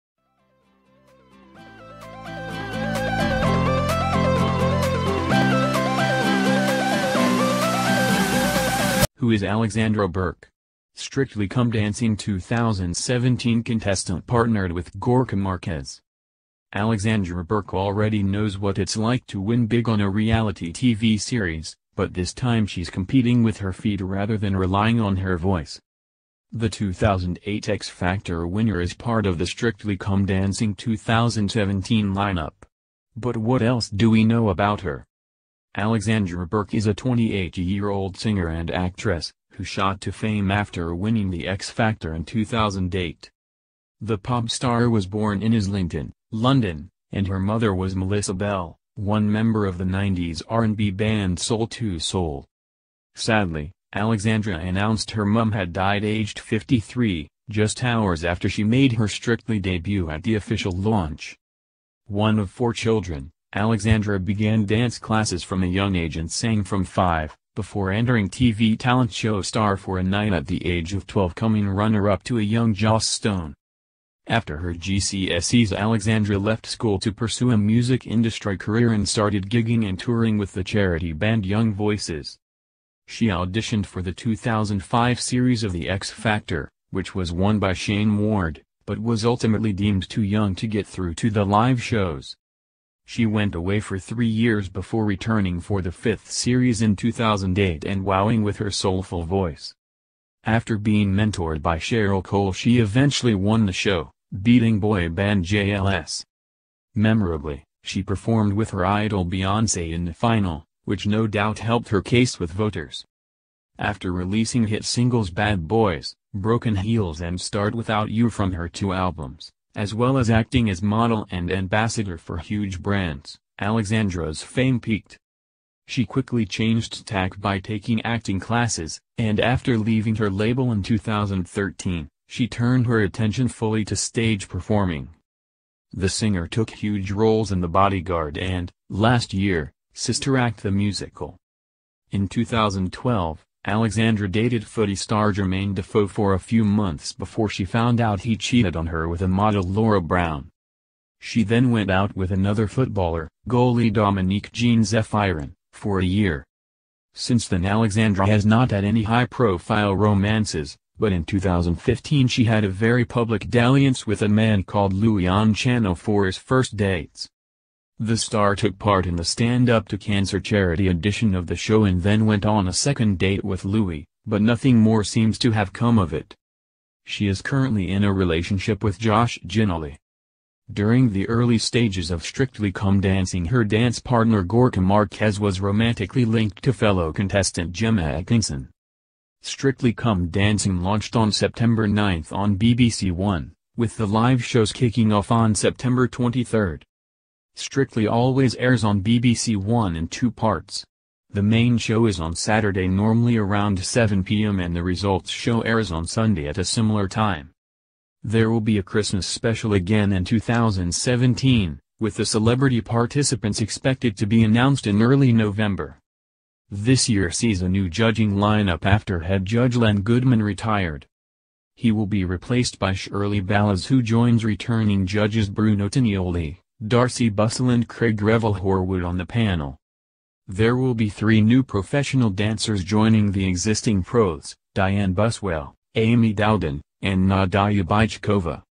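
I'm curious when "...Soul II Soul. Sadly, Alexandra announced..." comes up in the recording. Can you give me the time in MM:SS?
00:51.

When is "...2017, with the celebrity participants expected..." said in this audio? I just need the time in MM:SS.
03:30.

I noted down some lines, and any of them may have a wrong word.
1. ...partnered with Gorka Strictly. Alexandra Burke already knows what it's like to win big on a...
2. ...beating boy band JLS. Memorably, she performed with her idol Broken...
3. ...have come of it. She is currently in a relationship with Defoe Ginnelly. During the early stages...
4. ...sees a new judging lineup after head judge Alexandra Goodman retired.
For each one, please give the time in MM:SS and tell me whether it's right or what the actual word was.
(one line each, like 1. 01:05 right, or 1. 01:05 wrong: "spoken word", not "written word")
1. 00:14 wrong: "Marquez", not "Strictly"
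2. 01:44 wrong: "Beyoncé", not "Broken"
3. 02:55 wrong: "Josh", not "Defoe"
4. 03:37 wrong: "Len", not "Alexandra".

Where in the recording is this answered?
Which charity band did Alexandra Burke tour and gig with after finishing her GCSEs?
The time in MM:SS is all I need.
01:21.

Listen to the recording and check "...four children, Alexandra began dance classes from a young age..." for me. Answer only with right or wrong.
right.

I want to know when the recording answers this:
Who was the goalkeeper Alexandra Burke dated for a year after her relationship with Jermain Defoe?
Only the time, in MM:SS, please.
02:33.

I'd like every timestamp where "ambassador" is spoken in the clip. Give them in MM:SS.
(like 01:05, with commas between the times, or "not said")
02:01.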